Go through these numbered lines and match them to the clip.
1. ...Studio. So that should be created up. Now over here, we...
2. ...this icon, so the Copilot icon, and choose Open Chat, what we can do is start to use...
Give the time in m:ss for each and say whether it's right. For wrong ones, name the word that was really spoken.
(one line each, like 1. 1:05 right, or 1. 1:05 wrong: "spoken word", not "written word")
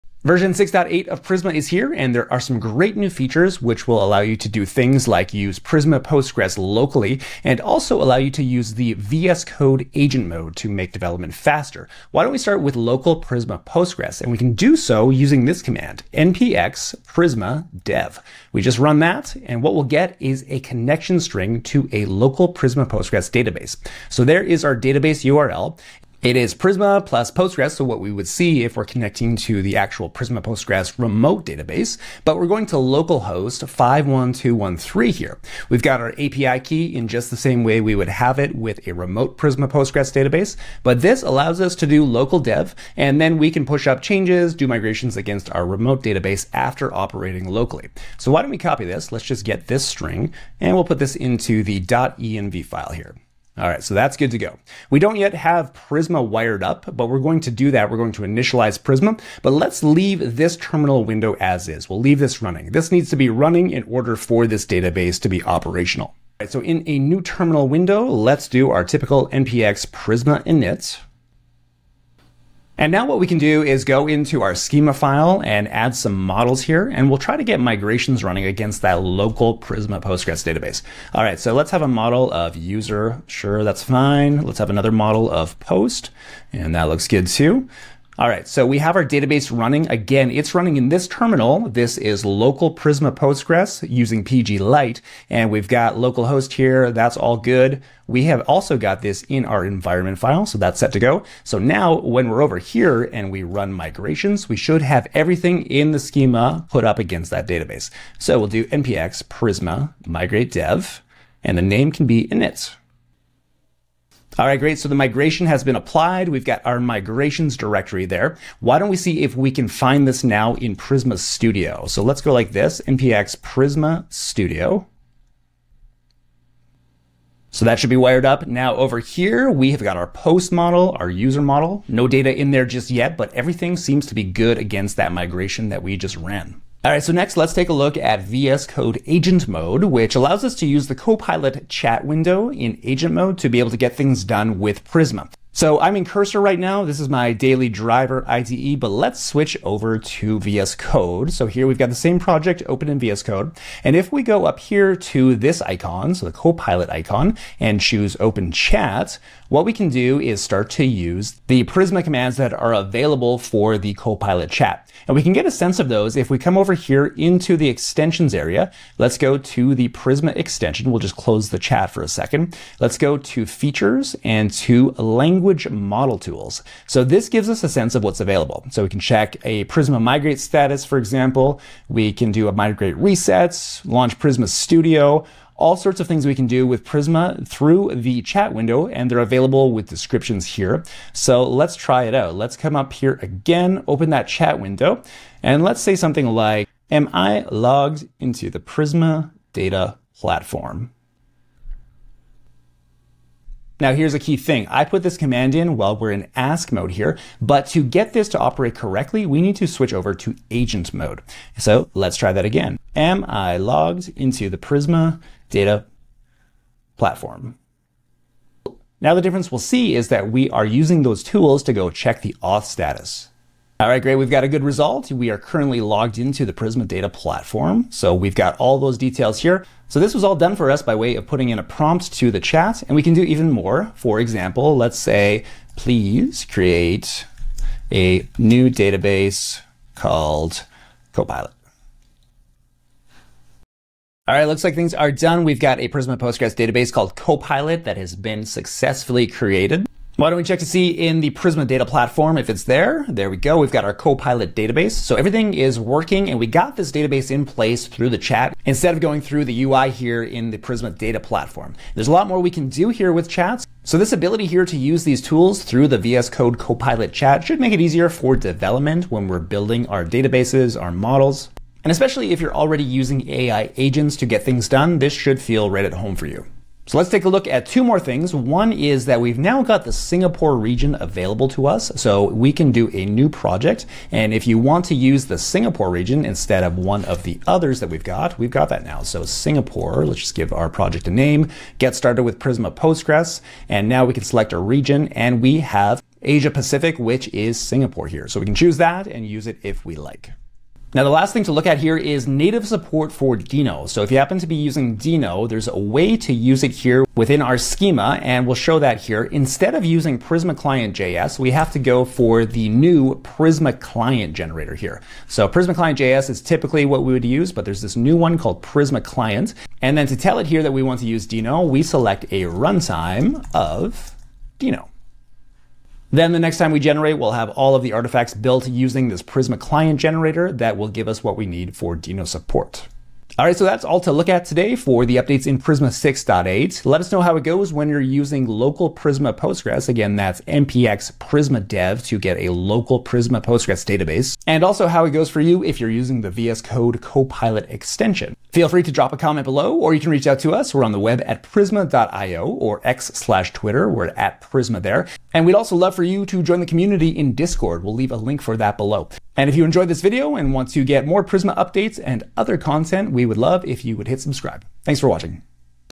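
1. 2:04 wrong: "wired", not "created"
2. 2:35 right.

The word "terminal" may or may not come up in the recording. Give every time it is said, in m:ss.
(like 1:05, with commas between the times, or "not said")
1:00, 1:07, 1:31.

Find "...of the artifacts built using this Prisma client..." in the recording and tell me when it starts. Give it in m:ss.
5:27.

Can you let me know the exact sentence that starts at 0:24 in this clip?
So there is our database URL.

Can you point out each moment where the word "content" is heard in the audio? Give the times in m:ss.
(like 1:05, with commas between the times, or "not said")
6:02.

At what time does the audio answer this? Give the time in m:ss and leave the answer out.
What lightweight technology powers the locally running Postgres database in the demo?
1:34.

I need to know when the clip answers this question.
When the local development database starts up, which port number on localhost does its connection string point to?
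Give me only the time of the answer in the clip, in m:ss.
0:33.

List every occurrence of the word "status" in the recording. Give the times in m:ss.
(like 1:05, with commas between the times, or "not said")
3:00, 3:42.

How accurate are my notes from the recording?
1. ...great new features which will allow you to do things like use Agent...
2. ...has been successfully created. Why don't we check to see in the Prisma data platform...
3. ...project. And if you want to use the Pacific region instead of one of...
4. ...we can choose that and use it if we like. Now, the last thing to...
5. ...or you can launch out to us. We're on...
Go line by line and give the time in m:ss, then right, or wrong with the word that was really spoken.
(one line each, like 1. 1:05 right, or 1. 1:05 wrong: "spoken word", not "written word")
1. 0:02 wrong: "Prisma", not "Agent"
2. 4:07 right
3. 4:43 wrong: "Singapore", not "Pacific"
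4. 4:58 right
5. 5:49 wrong: "reach", not "launch".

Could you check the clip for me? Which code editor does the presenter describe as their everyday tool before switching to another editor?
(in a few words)
Cursor.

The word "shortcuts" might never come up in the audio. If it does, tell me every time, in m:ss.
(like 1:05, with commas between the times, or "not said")
not said.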